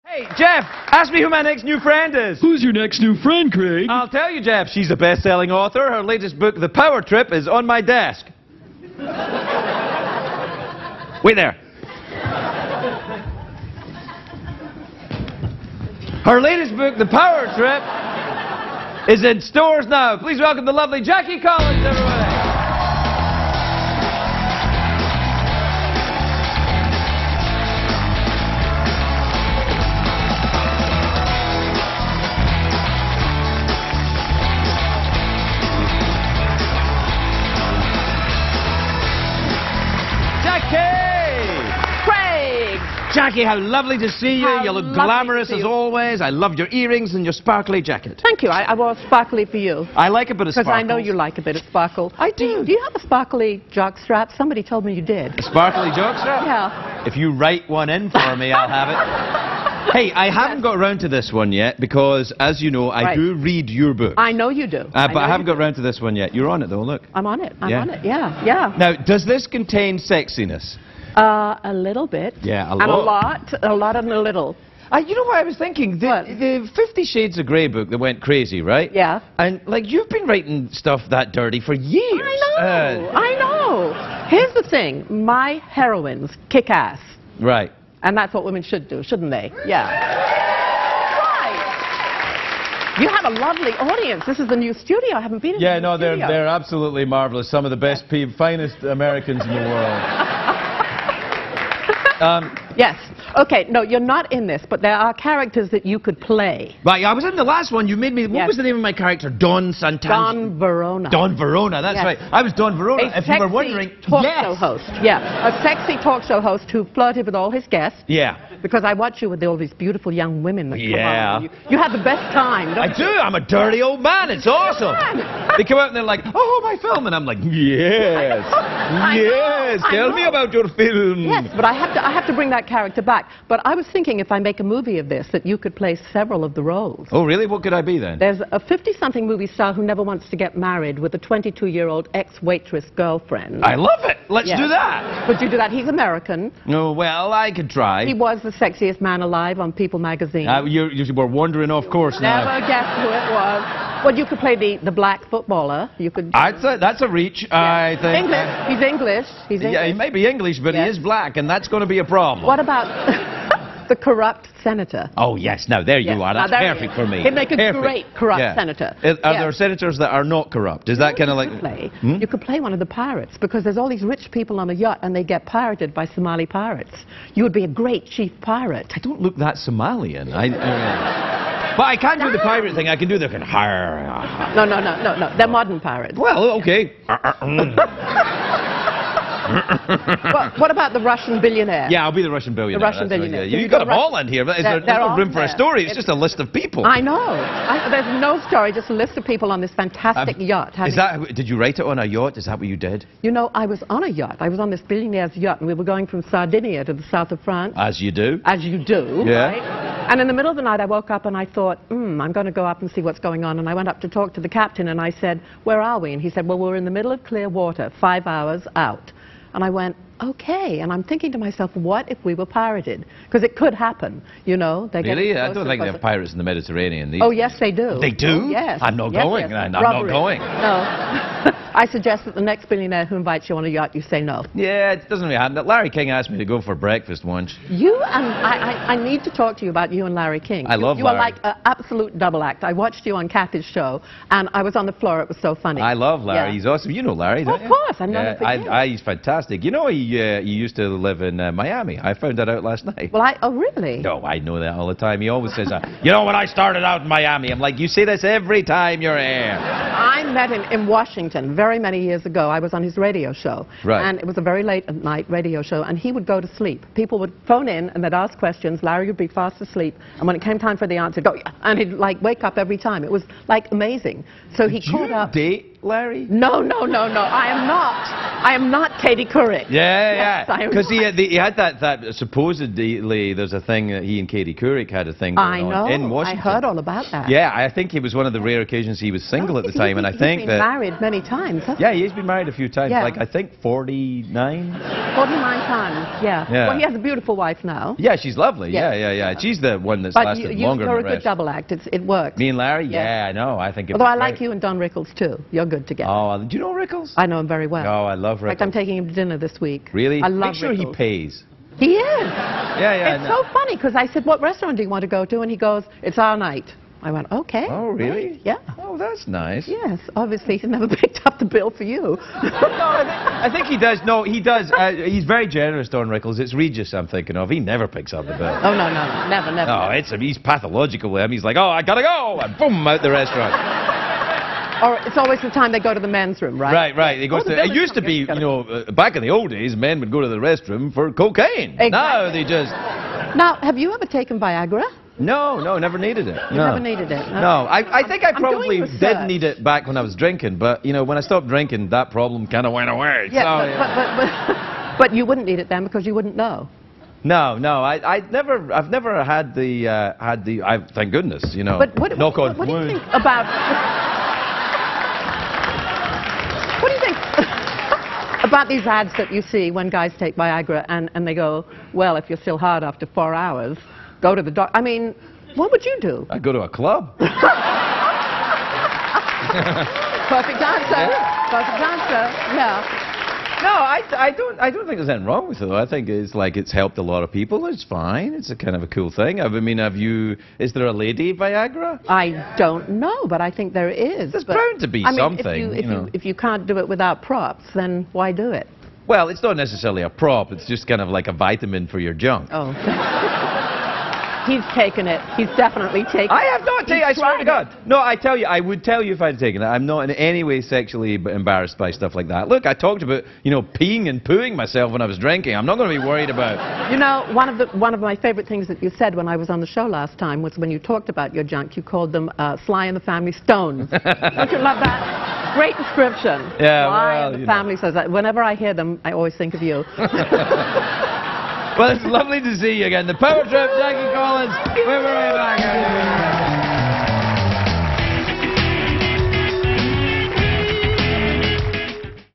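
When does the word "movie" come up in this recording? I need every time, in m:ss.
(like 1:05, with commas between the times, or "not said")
2:14, 2:19.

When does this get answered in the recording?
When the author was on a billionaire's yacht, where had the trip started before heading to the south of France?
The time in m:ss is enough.
3:26.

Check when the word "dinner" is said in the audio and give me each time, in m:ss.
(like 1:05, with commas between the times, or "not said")
5:09.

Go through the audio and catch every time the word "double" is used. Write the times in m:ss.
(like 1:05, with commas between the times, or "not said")
4:02, 5:01.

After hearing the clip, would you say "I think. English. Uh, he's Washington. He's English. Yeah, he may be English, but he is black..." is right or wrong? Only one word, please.
wrong.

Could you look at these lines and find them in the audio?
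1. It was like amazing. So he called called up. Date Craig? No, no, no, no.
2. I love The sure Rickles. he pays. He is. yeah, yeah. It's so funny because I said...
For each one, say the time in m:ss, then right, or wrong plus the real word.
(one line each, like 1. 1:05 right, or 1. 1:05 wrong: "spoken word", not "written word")
1. 4:33 wrong: "Larry", not "Craig"
2. 5:10 wrong: "Make", not "The".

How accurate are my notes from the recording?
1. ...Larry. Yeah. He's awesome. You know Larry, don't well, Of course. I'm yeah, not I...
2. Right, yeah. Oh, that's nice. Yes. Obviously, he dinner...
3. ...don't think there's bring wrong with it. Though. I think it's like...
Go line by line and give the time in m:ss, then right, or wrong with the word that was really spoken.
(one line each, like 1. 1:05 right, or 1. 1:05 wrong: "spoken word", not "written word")
1. 4:06 right
2. 5:18 wrong: "never", not "dinner"
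3. 6:24 wrong: "anything", not "bring".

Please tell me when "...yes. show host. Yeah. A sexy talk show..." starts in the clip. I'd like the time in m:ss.
1:54.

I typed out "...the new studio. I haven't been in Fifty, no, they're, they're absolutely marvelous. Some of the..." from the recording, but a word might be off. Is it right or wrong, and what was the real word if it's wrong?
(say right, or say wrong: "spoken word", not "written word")
wrong: "Yeah", not "Fifty".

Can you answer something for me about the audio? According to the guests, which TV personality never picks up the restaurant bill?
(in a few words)
Regis.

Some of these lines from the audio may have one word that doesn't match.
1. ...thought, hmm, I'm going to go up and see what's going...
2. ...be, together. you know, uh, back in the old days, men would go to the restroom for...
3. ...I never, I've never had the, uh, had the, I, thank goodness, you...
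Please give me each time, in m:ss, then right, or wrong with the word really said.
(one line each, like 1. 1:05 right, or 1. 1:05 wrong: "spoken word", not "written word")
1. 3:31 right
2. 5:38 right
3. 5:58 right.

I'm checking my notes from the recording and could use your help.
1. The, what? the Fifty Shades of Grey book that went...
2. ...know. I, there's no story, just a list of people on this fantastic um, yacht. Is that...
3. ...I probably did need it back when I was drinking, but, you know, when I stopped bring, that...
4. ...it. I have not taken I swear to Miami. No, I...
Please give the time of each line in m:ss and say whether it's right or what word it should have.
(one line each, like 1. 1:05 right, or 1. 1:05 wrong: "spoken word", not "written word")
1. 1:15 right
2. 3:17 right
3. 5:48 wrong: "drinking", not "bring"
4. 6:46 wrong: "God", not "Miami".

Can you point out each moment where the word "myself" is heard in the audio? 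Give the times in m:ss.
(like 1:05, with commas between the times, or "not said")
3:41, 6:54.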